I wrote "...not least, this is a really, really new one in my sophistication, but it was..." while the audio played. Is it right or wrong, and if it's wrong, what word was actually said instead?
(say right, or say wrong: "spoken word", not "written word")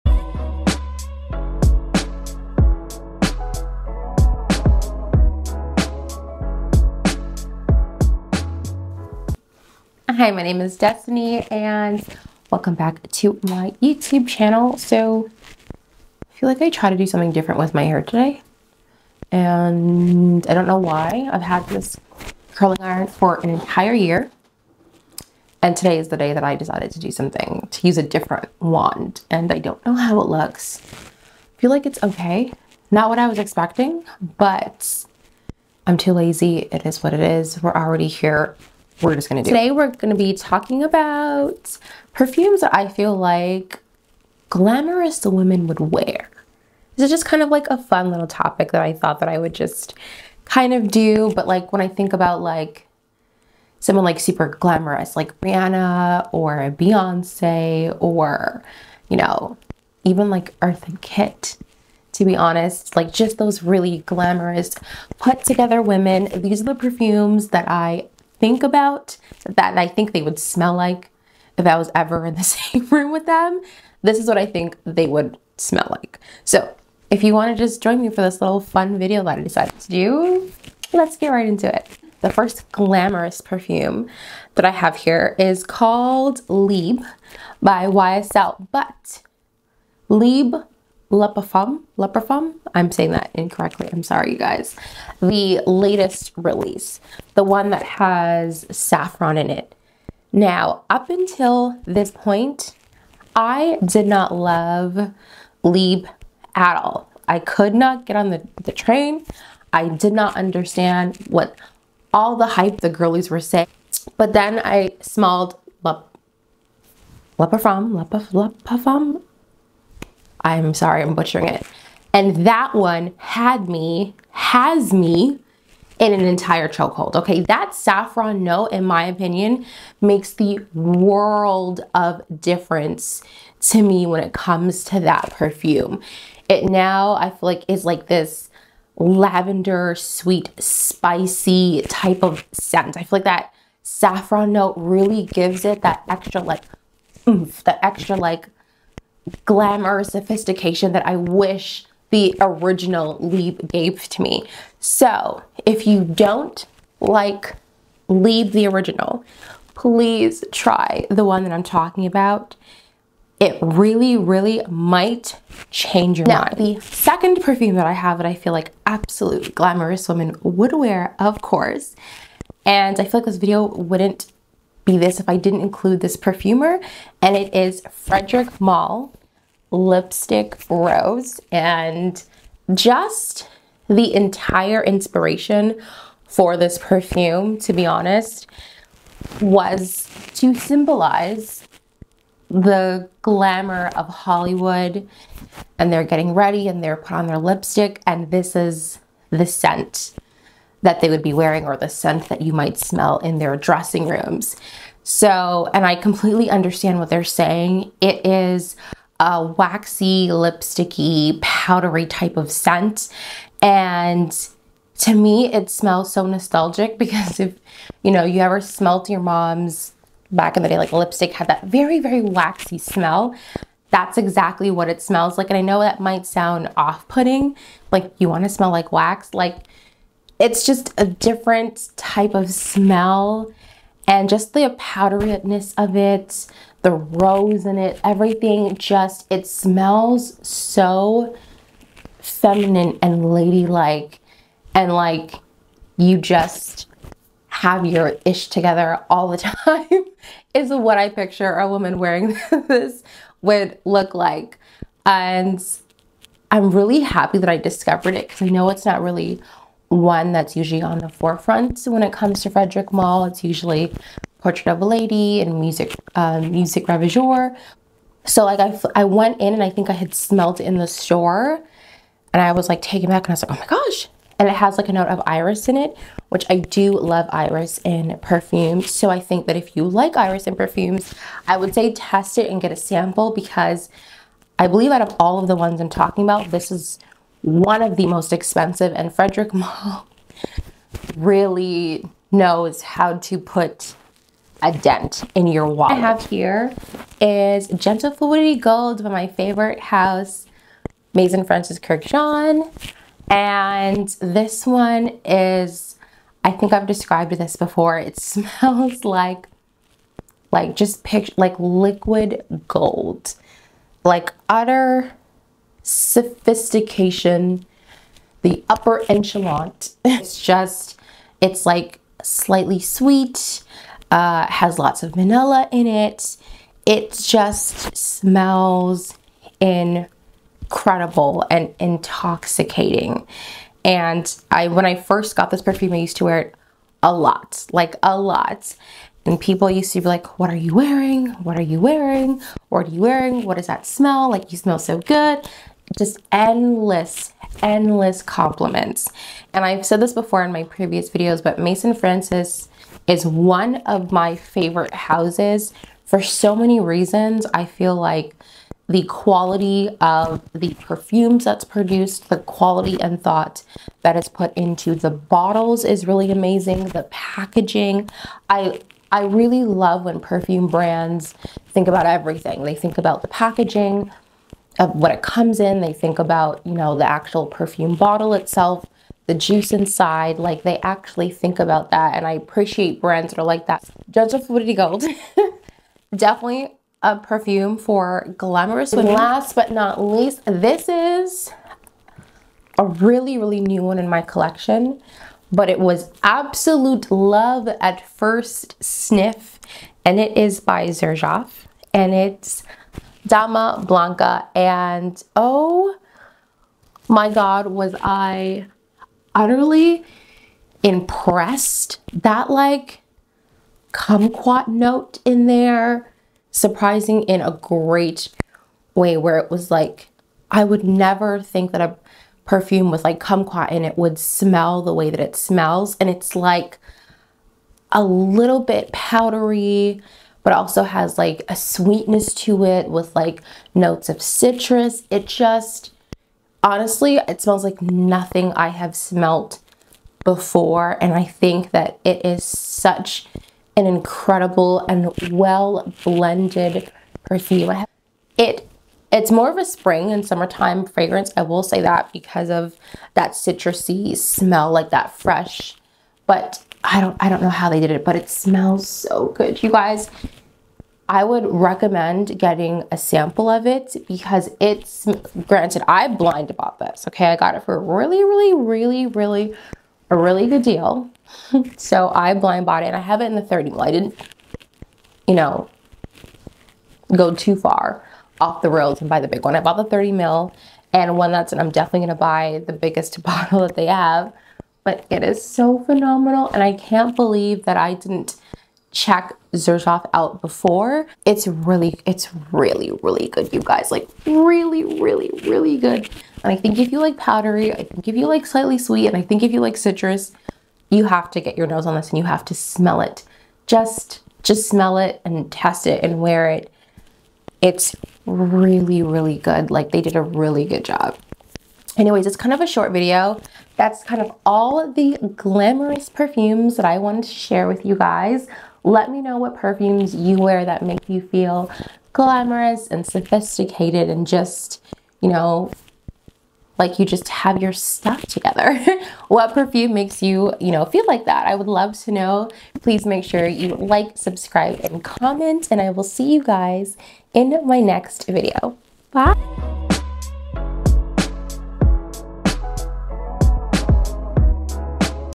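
wrong: "collection", not "sophistication".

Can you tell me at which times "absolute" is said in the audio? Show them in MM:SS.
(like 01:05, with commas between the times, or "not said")
02:48, 06:36.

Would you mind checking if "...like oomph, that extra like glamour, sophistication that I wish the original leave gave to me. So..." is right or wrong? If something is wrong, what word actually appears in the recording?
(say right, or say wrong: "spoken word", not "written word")
right.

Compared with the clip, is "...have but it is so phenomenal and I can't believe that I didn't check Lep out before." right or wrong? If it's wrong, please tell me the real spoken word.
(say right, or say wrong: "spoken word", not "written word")
wrong: "Xerjoff", not "Lep".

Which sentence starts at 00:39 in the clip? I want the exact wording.
Today we're gonna be talking about perfumes that I feel like glamorous women would wear.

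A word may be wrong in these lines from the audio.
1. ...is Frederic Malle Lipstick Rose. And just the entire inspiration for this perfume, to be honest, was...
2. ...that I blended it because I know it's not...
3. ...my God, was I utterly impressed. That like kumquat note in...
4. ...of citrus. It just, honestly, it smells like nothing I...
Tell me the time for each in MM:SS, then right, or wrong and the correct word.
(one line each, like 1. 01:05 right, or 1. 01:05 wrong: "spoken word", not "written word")
1. 02:57 right
2. 04:17 wrong: "discovered", not "blended"
3. 06:47 right
4. 07:14 right.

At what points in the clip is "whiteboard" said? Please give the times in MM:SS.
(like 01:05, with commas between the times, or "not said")
not said.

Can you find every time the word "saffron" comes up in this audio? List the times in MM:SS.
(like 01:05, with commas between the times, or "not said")
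01:38, 02:07, 02:23.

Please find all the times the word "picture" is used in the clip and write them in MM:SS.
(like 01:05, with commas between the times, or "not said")
04:11, 05:11.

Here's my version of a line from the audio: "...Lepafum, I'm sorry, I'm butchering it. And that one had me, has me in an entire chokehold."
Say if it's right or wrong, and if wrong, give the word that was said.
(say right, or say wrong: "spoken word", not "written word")
right.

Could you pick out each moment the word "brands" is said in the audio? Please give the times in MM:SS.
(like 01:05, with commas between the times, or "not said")
06:10, 06:23.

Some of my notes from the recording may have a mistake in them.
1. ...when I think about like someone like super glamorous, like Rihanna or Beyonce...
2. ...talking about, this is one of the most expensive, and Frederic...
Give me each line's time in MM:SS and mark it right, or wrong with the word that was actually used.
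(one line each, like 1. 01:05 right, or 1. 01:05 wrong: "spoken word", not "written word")
1. 00:51 right
2. 04:45 right.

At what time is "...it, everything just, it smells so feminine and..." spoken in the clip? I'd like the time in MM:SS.
03:57.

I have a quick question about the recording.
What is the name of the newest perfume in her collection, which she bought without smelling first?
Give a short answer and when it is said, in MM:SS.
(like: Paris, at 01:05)
Dama Bianca, at 06:43.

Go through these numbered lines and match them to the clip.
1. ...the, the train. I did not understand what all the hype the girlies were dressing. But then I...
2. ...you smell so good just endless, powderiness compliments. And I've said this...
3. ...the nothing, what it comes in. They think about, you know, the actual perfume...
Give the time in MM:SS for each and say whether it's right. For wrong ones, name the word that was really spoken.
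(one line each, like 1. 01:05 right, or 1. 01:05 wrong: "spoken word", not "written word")
1. 01:48 wrong: "saying", not "dressing"
2. 05:44 wrong: "endless", not "powderiness"
3. 06:13 wrong: "packaging", not "nothing".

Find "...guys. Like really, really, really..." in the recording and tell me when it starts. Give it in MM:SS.
08:13.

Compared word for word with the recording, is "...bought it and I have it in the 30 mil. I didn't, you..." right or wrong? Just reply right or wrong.
right.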